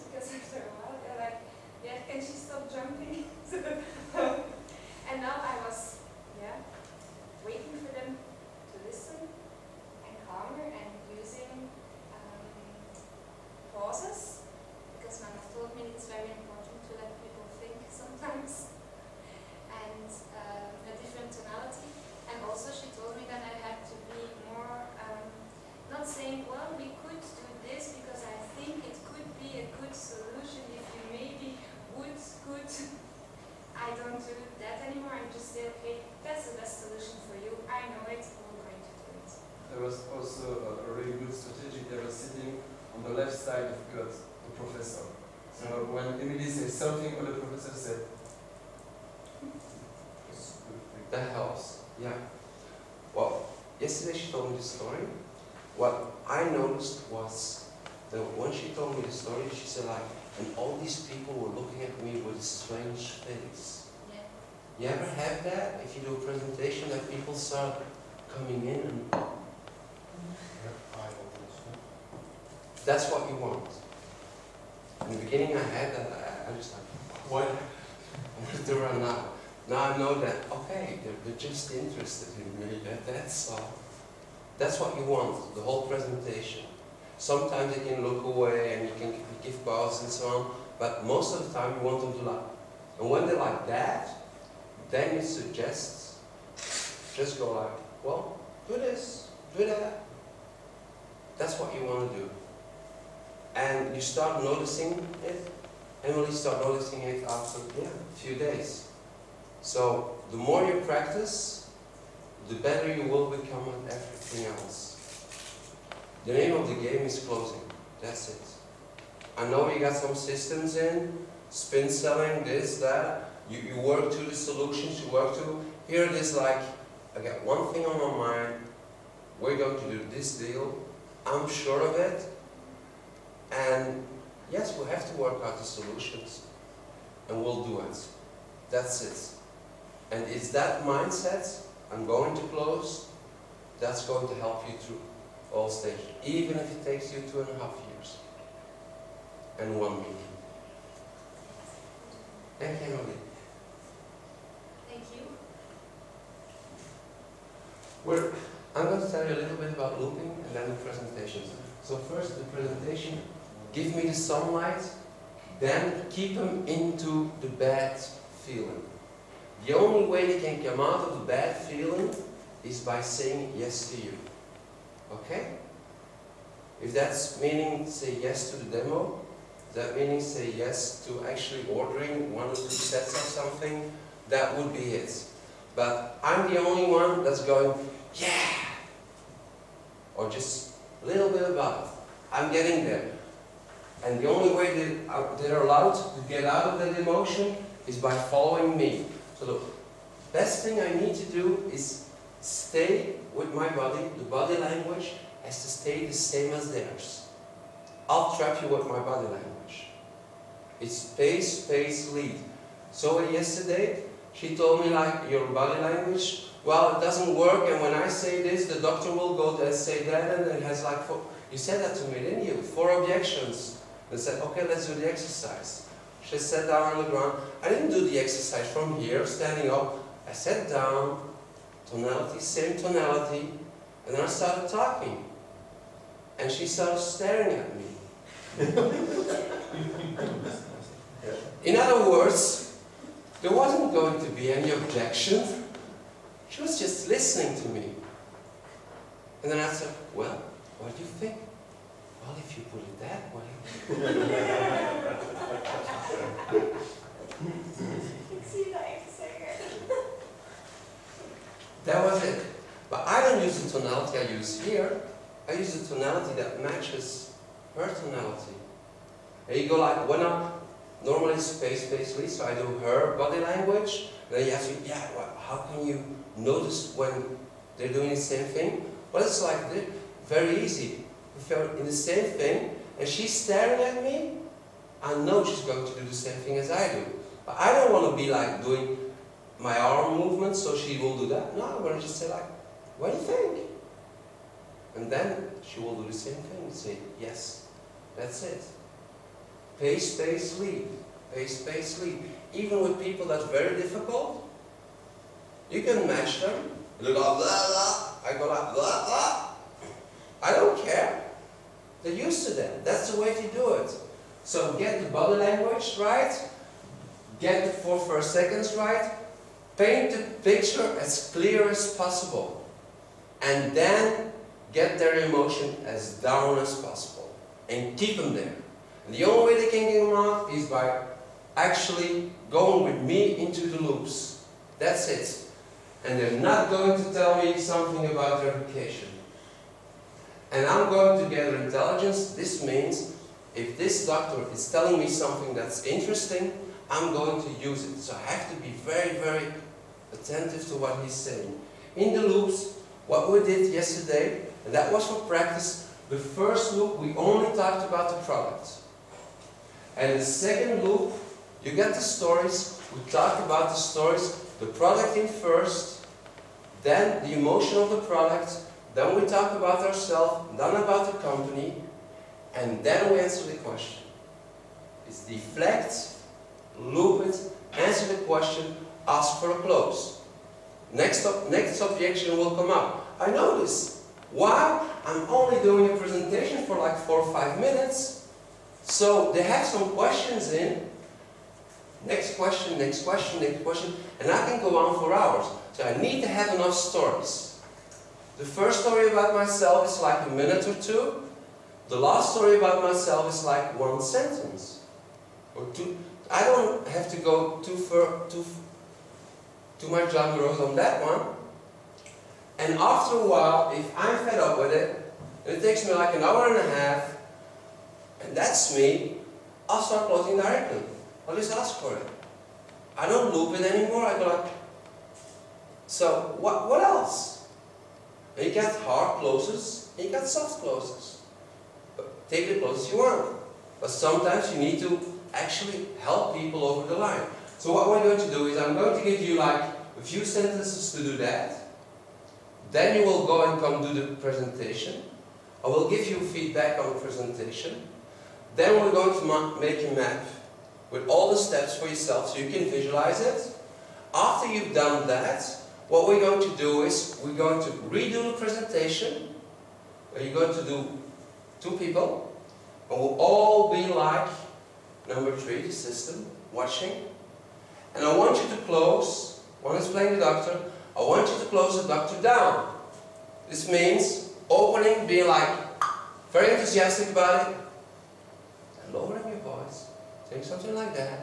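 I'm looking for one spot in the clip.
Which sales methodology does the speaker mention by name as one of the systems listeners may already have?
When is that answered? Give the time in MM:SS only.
02:01.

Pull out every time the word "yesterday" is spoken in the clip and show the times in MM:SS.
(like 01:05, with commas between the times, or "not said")
03:33, 05:53.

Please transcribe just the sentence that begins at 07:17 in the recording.
So what we're going to do is I'm going to give you like a few sentences to do that.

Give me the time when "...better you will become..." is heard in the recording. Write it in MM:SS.
01:52.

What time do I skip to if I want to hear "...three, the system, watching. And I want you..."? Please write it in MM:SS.
07:45.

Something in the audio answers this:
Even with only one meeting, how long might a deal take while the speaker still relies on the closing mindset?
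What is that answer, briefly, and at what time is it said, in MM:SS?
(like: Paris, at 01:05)
Two and a half years, at 02:27.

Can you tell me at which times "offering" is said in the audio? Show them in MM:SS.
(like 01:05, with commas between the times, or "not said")
not said.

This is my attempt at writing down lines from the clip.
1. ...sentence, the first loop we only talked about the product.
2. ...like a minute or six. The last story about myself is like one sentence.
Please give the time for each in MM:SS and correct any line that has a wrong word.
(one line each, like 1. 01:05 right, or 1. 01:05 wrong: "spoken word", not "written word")
1. 05:55 wrong: "practice", not "sentence"
2. 06:39 wrong: "two", not "six".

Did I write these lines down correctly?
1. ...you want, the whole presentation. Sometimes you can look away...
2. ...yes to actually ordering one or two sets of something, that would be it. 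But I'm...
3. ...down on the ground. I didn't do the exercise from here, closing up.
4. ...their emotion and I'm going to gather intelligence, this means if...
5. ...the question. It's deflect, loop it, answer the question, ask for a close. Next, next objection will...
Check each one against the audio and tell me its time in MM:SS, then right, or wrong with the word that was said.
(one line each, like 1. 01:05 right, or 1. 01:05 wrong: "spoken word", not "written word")
1. 01:24 right
2. 03:00 right
3. 03:46 wrong: "standing", not "closing"
4. 05:38 wrong: "vacation", not "emotion"
5. 06:13 right.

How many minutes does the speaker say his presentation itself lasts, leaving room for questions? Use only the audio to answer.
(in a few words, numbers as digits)
4 or 5 minutes.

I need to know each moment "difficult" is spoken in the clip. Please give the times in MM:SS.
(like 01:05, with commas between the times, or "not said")
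05:03.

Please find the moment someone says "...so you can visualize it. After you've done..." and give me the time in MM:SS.
07:32.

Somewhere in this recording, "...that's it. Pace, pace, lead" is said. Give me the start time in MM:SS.
04:58.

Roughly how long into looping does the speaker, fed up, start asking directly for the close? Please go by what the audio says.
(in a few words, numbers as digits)
An hour and a half.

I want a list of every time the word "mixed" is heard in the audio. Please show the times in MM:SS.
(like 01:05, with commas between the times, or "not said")
not said.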